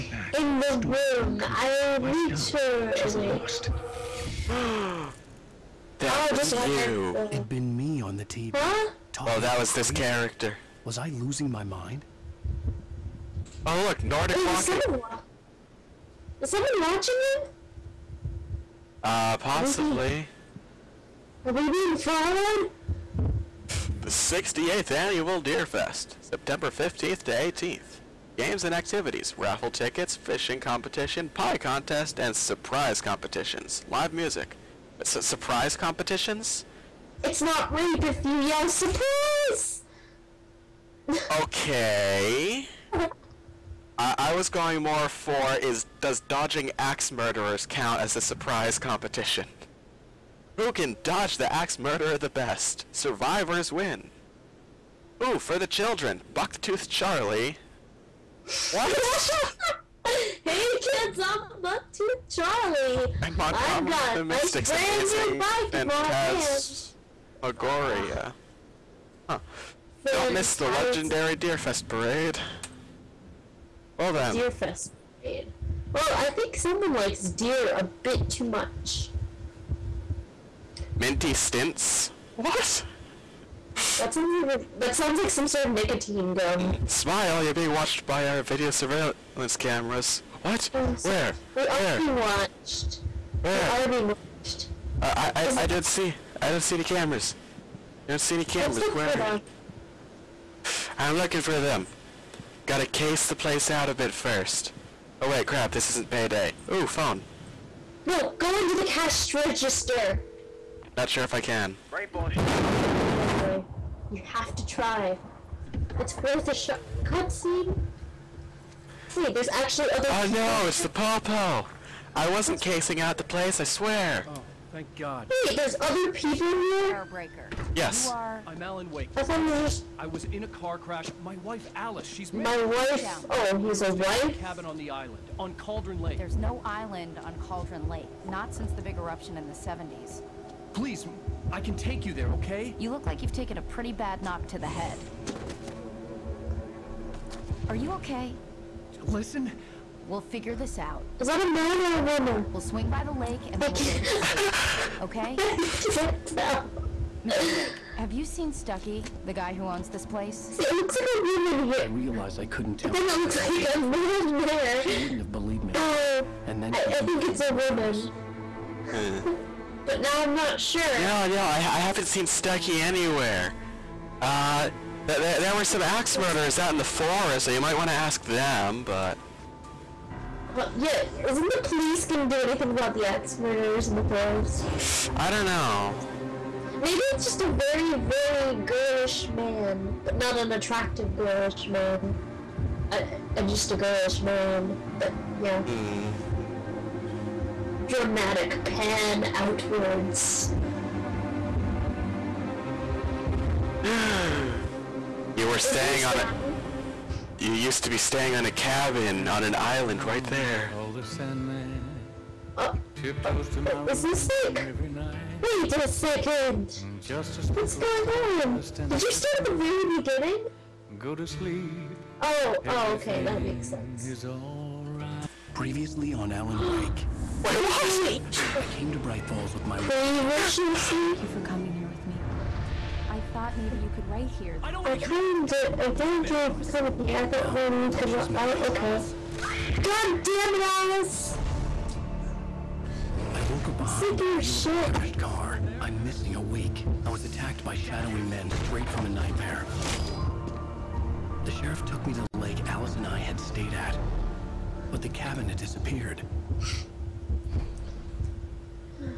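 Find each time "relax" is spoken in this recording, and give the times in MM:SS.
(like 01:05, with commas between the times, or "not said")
not said.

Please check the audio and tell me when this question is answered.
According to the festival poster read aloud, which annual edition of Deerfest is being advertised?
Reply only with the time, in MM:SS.
00:24.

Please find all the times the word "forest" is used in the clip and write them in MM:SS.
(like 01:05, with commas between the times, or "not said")
02:56, 03:04.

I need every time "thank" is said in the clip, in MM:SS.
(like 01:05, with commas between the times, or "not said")
02:04, 03:55.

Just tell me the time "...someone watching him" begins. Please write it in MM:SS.
00:16.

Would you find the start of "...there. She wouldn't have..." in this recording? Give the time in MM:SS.
02:44.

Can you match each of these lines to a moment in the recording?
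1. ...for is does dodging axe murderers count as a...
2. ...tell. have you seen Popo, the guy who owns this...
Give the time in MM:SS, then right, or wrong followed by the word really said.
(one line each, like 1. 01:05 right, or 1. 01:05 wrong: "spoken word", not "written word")
1. 00:45 right
2. 02:36 wrong: "Stucky", not "Popo".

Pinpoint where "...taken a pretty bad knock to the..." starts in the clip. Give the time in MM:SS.
02:23.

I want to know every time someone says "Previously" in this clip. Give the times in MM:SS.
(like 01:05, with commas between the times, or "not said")
03:45, 03:49.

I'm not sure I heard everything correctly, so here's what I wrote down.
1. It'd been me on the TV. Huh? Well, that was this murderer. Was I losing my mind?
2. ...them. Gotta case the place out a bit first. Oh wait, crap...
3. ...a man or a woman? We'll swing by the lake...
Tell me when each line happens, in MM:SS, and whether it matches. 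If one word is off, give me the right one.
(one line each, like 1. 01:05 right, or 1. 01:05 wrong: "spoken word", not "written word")
1. 00:07 wrong: "character", not "murderer"
2. 01:41 right
3. 02:31 right.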